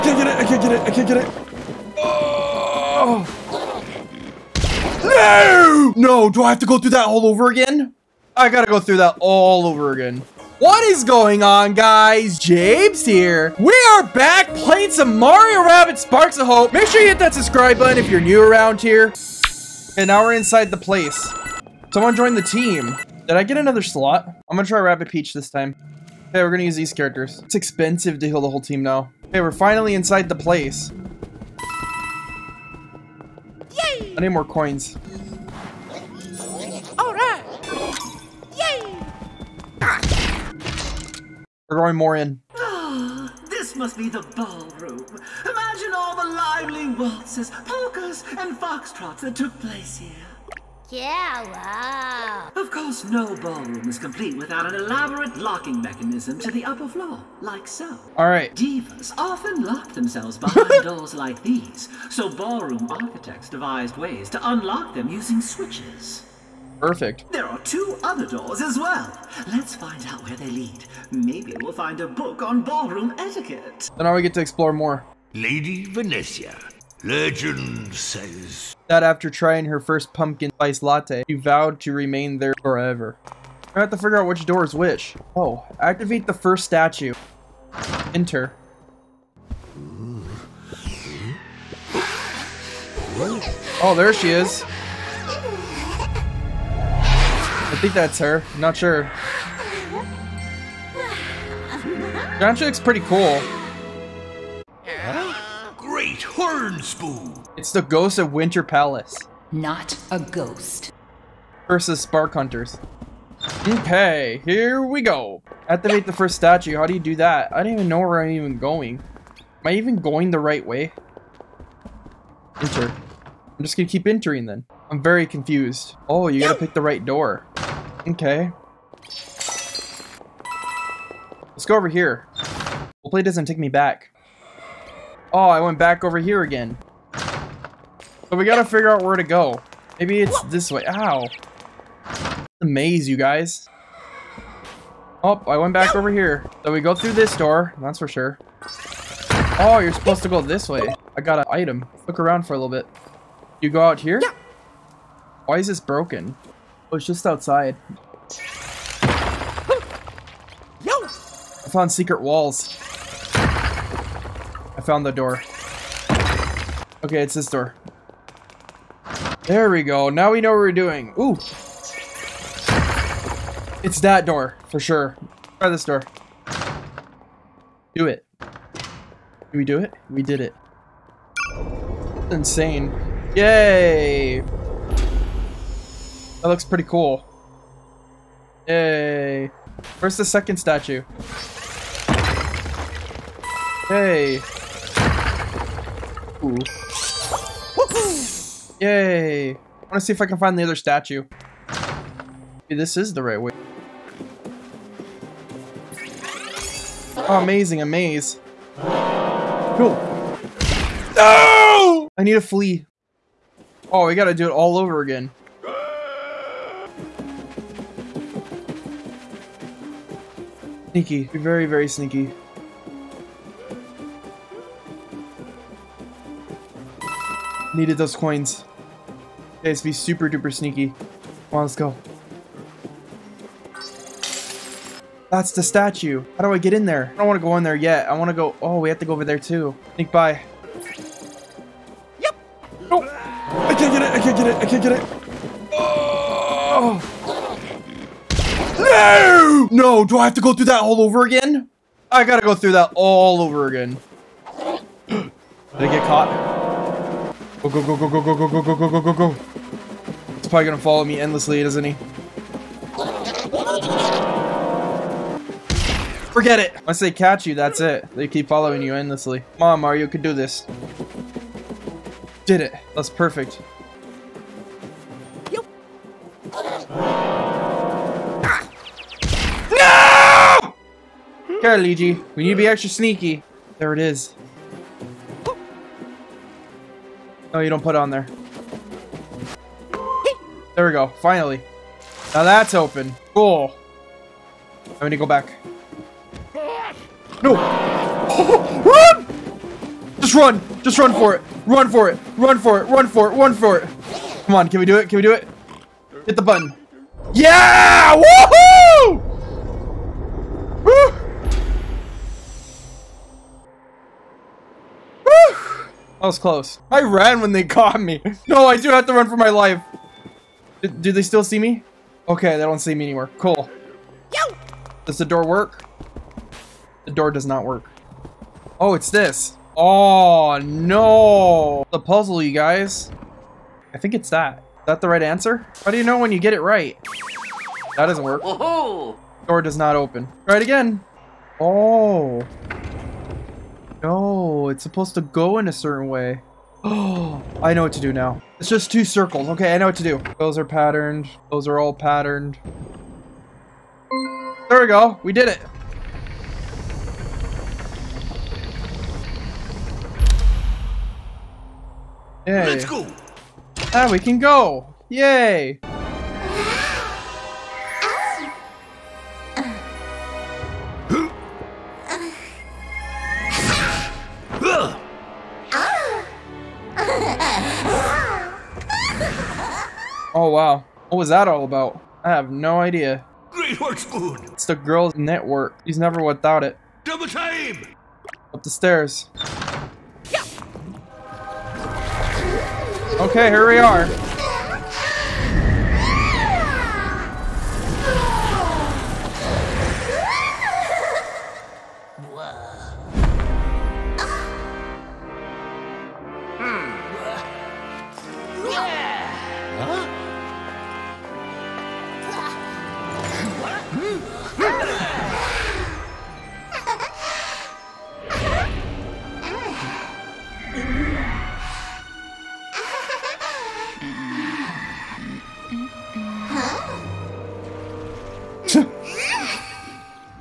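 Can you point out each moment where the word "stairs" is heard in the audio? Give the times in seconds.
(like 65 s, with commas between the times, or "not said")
388 s.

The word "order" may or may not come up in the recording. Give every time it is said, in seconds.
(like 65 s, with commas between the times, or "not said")
not said.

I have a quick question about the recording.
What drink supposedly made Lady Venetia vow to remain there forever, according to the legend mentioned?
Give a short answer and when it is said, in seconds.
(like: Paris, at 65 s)
pumpkin spice latte, at 80 s.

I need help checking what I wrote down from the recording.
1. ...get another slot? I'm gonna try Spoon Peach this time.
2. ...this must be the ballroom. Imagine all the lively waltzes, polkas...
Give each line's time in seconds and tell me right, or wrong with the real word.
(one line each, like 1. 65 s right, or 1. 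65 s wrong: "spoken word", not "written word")
1. 23 s wrong: "Rabbid", not "Spoon"
2. 43 s right.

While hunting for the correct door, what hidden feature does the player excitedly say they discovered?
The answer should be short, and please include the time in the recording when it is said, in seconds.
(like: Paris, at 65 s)
secret walls, at 161 s.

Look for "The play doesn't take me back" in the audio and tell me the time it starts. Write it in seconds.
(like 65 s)
132 s.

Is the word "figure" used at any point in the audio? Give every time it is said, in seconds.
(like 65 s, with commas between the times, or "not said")
83 s, 138 s.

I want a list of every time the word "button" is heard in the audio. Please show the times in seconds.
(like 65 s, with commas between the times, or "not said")
17 s, 306 s.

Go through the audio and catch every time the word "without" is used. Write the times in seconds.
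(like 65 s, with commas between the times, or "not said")
54 s, 386 s.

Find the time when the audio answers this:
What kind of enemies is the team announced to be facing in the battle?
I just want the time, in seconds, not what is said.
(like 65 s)
111 s.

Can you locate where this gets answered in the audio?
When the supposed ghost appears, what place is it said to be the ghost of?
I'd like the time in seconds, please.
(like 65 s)
108 s.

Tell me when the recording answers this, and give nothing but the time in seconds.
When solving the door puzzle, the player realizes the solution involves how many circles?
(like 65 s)
348 s.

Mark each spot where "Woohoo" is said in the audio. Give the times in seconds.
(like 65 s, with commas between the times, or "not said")
308 s.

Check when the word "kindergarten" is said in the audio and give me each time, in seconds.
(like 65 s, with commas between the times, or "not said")
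not said.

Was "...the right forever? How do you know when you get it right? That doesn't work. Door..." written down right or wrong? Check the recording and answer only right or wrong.
wrong.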